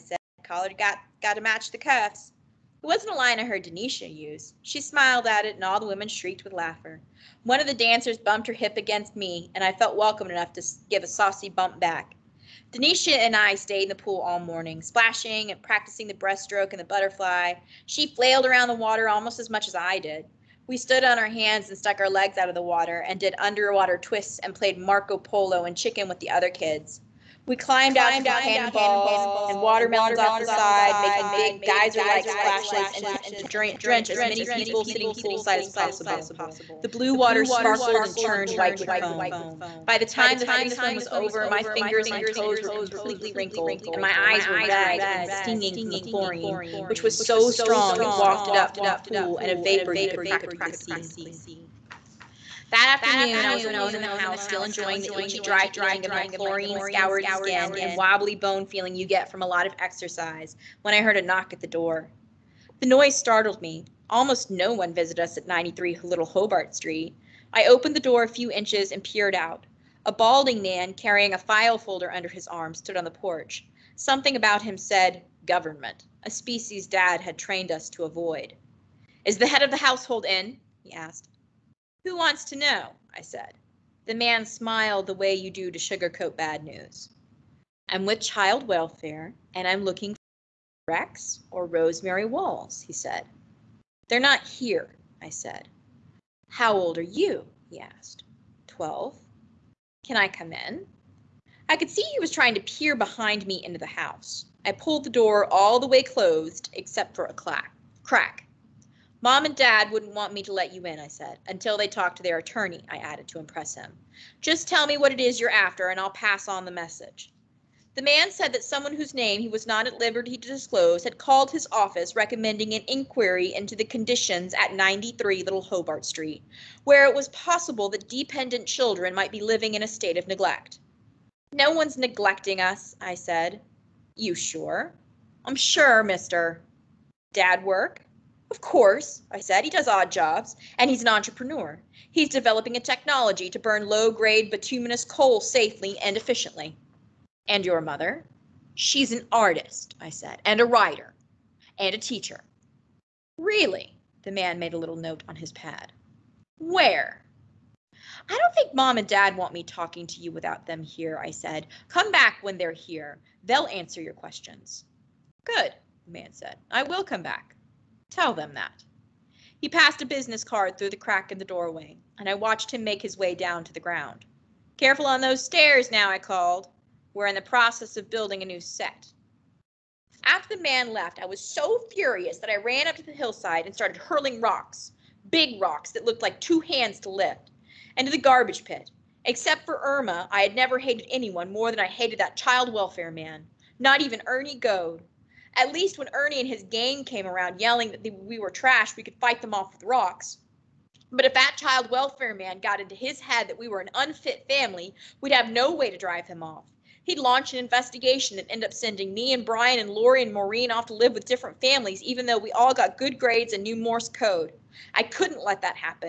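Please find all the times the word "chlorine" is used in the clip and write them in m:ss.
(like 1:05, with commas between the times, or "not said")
0:45, 0:56.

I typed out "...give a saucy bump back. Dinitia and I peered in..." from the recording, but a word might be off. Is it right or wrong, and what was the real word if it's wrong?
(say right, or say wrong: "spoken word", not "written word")
wrong: "stayed", not "peered".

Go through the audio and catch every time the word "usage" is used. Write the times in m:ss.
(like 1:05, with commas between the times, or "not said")
not said.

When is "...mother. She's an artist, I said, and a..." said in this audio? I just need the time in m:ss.
2:27.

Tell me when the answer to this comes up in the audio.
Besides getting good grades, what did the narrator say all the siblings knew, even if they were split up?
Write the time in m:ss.
3:33.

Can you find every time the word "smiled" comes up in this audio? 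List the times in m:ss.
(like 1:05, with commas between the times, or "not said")
0:04, 1:24.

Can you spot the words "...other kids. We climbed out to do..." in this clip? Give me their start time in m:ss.
0:26.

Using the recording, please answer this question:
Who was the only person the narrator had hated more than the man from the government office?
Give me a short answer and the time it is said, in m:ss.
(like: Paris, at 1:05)
Irma, at 3:09.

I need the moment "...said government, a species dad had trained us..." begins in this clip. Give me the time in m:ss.
1:14.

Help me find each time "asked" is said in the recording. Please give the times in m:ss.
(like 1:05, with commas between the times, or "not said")
1:20, 1:37.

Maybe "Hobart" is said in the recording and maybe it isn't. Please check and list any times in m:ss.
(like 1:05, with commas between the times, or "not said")
1:06, 2:05.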